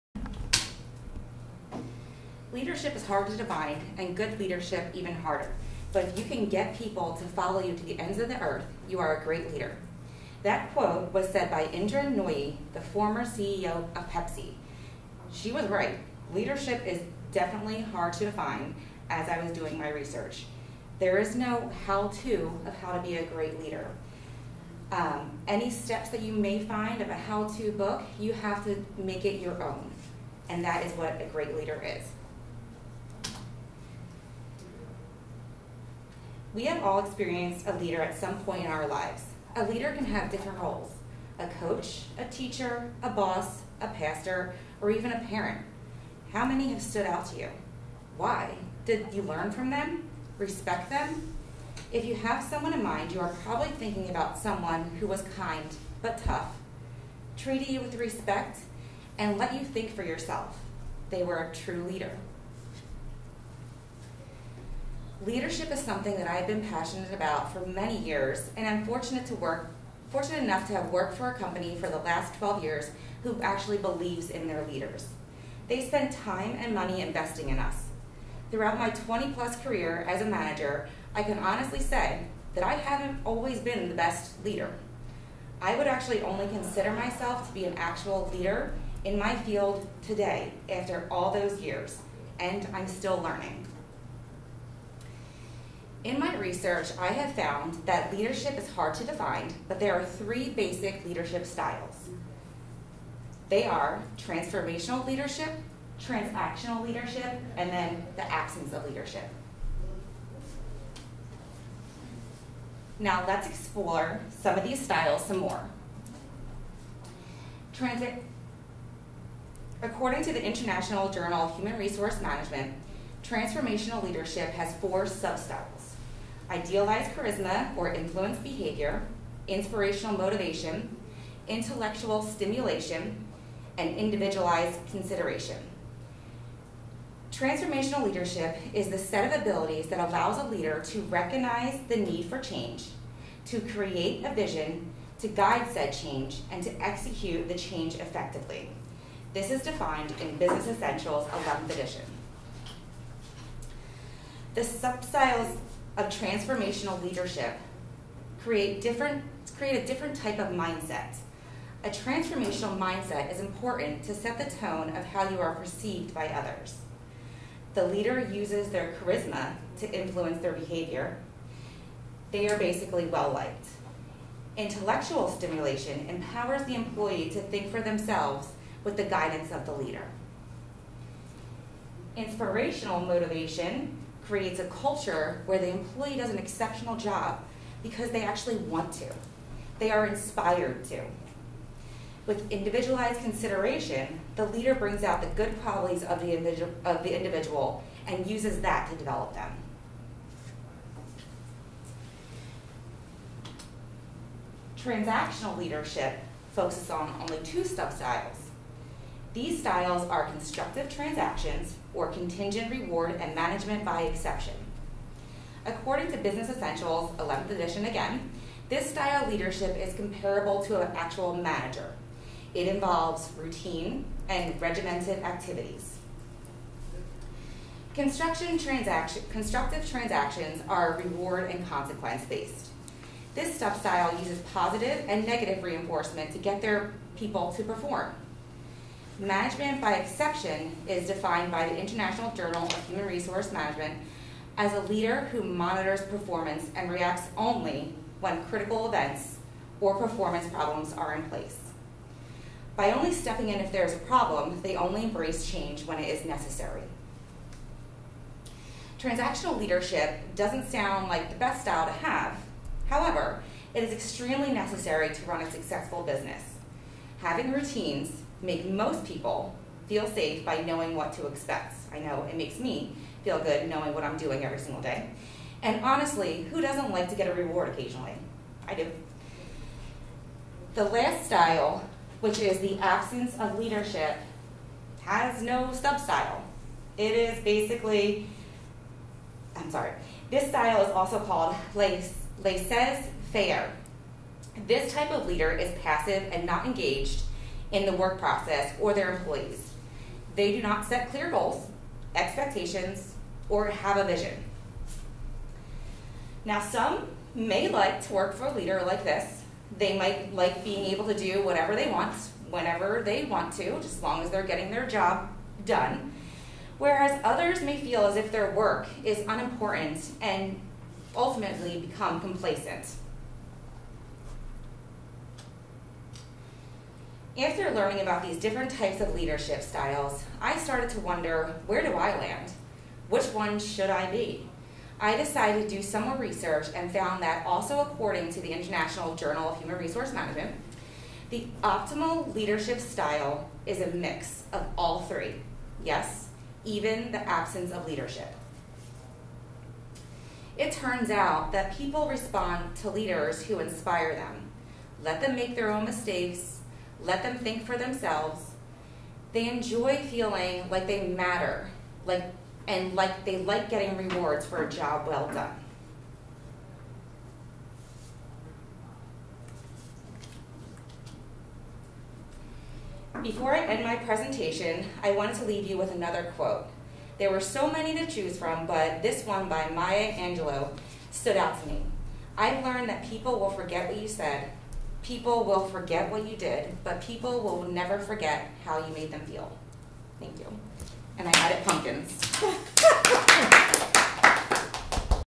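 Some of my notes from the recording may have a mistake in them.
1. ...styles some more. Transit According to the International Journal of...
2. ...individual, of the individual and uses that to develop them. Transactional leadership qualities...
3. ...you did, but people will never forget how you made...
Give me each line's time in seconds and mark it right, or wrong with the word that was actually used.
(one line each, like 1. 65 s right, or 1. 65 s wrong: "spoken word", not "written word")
1. 114 s right
2. 196 s wrong: "focuses", not "qualities"
3. 386 s right.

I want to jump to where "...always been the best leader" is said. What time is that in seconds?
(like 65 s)
83 s.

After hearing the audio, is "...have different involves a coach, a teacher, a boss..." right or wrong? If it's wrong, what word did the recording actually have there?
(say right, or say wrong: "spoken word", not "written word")
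wrong: "roles", not "involves".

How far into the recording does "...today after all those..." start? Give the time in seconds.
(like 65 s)
90 s.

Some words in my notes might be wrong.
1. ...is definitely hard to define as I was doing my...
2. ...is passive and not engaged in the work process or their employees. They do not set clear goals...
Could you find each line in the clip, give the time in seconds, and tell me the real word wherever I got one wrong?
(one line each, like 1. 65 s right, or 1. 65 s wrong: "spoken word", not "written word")
1. 16 s right
2. 295 s right.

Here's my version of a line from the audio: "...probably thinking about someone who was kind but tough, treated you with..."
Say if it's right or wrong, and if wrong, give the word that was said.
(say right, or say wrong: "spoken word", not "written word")
right.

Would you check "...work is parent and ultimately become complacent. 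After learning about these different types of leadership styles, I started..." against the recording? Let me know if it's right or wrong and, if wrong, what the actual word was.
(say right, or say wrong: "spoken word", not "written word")
wrong: "unimportant", not "parent".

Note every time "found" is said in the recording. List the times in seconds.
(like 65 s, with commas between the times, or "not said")
97 s, 336 s.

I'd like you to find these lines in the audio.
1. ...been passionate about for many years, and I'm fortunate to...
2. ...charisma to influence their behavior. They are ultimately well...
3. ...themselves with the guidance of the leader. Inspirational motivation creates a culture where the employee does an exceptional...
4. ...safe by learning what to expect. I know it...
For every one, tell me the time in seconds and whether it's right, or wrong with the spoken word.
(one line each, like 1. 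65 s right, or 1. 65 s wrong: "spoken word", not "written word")
1. 66 s right
2. 168 s wrong: "basically", not "ultimately"
3. 177 s right
4. 270 s wrong: "knowing", not "learning".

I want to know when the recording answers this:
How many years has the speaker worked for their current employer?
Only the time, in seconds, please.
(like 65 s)
72 s.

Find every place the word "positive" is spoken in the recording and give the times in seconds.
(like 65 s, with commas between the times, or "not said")
234 s.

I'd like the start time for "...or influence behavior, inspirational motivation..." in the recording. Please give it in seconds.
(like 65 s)
127 s.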